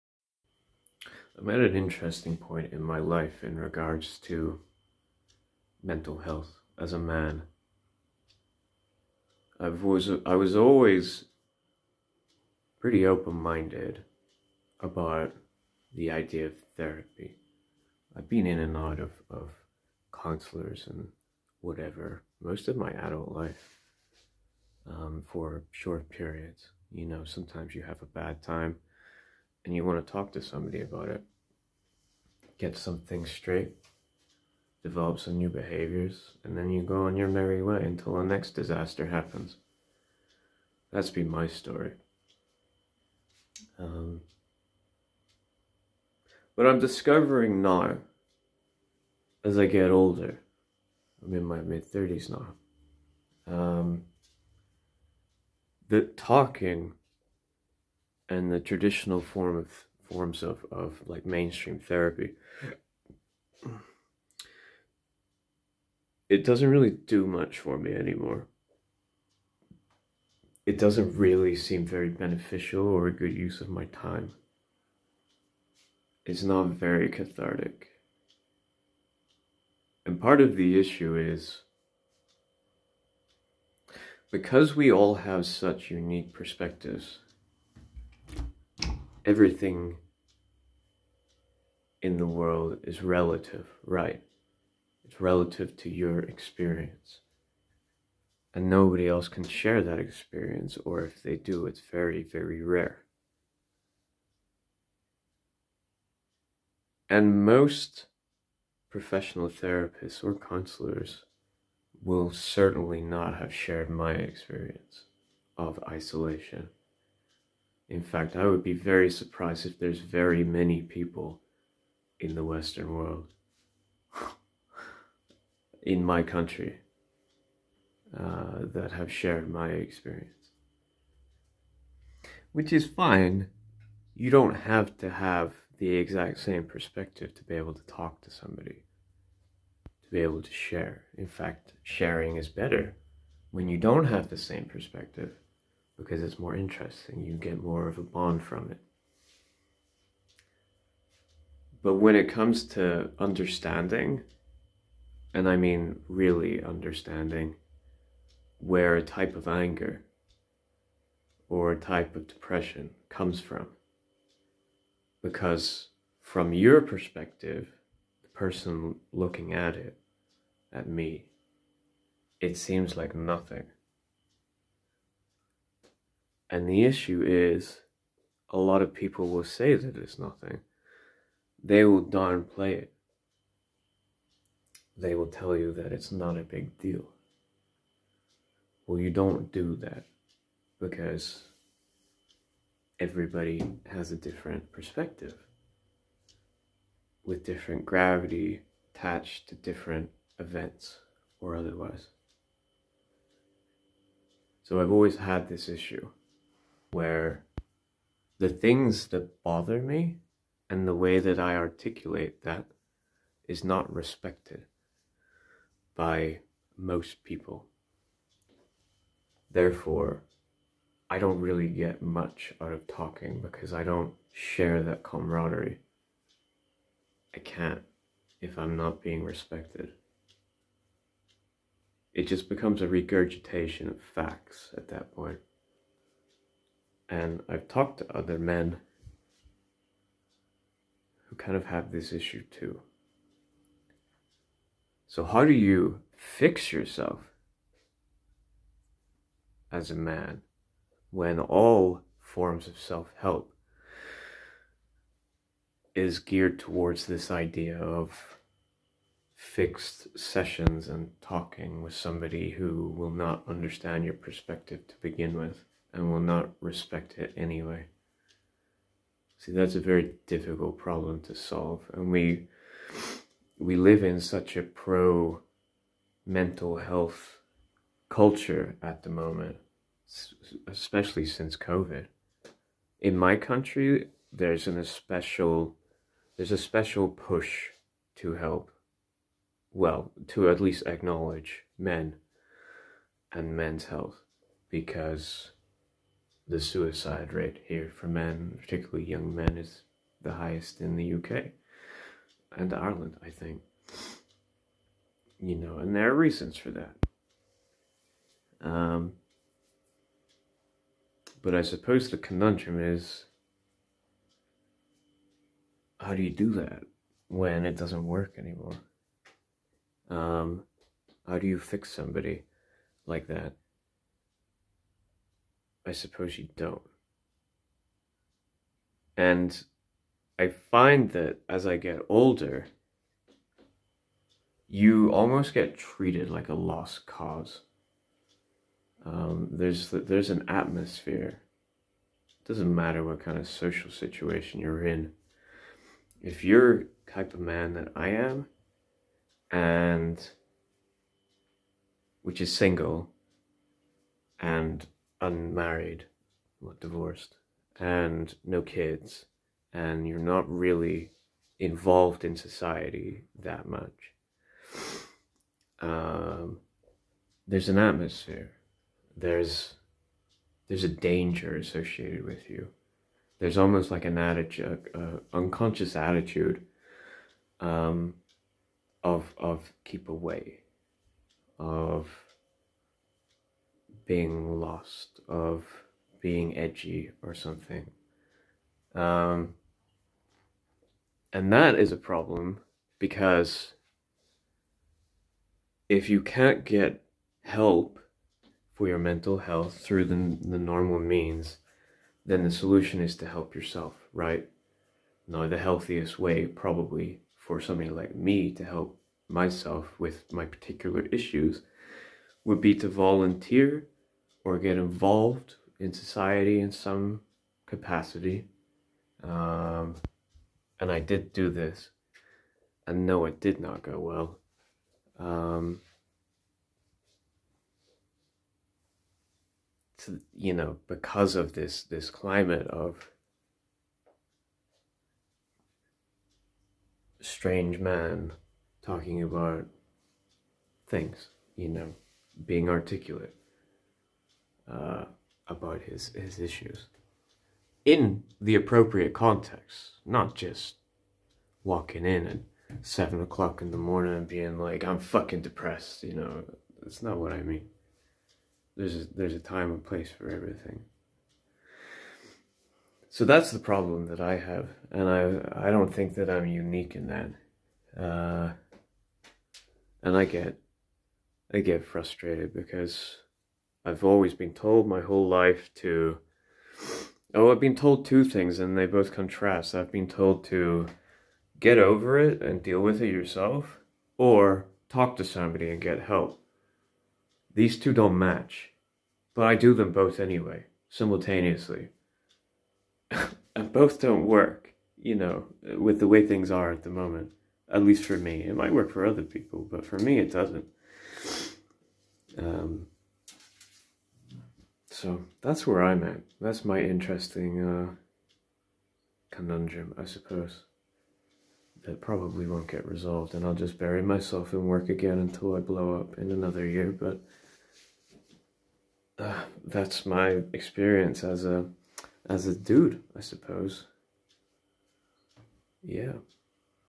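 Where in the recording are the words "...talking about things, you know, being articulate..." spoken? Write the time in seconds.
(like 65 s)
438 s.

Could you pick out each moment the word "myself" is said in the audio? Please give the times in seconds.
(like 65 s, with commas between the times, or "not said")
409 s, 514 s.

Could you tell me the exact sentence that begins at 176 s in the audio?
And the issue is, a lot of people will say that it's nothing.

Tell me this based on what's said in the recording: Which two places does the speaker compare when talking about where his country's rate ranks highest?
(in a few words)
UK and Ireland.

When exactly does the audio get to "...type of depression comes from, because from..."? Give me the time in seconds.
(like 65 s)
161 s.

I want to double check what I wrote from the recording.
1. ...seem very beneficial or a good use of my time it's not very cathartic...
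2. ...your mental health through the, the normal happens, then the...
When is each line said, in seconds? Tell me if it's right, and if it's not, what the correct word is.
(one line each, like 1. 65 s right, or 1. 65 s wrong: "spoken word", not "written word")
1. 71 s right
2. 398 s wrong: "means", not "happens".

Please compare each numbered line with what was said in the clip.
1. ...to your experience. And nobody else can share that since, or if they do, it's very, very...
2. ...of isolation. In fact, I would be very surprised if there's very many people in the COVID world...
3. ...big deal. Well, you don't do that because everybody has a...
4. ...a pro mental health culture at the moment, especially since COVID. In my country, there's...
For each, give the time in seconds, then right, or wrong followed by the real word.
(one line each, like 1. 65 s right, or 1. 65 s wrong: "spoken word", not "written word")
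1. 95 s wrong: "experience", not "since"
2. 115 s wrong: "Western", not "COVID"
3. 186 s right
4. 274 s right.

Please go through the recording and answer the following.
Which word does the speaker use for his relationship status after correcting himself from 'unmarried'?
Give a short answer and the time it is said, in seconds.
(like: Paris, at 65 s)
divorced, at 356 s.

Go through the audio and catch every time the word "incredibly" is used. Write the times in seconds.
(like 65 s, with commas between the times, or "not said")
not said.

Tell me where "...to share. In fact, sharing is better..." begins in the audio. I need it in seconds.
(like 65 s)
140 s.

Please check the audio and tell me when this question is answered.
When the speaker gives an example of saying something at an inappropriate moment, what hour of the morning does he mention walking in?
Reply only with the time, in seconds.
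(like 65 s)
452 s.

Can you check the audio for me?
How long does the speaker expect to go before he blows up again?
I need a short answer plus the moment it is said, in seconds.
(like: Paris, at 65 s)
another year, at 516 s.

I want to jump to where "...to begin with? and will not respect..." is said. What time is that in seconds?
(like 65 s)
264 s.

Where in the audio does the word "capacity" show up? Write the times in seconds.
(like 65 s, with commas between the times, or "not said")
417 s.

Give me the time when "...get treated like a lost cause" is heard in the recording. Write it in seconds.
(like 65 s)
335 s.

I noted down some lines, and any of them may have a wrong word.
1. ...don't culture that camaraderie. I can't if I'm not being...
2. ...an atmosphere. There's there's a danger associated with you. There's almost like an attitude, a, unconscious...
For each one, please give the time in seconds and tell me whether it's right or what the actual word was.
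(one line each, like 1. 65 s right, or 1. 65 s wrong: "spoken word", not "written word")
1. 223 s wrong: "share", not "culture"
2. 367 s right.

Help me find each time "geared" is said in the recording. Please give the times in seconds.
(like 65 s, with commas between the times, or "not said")
256 s.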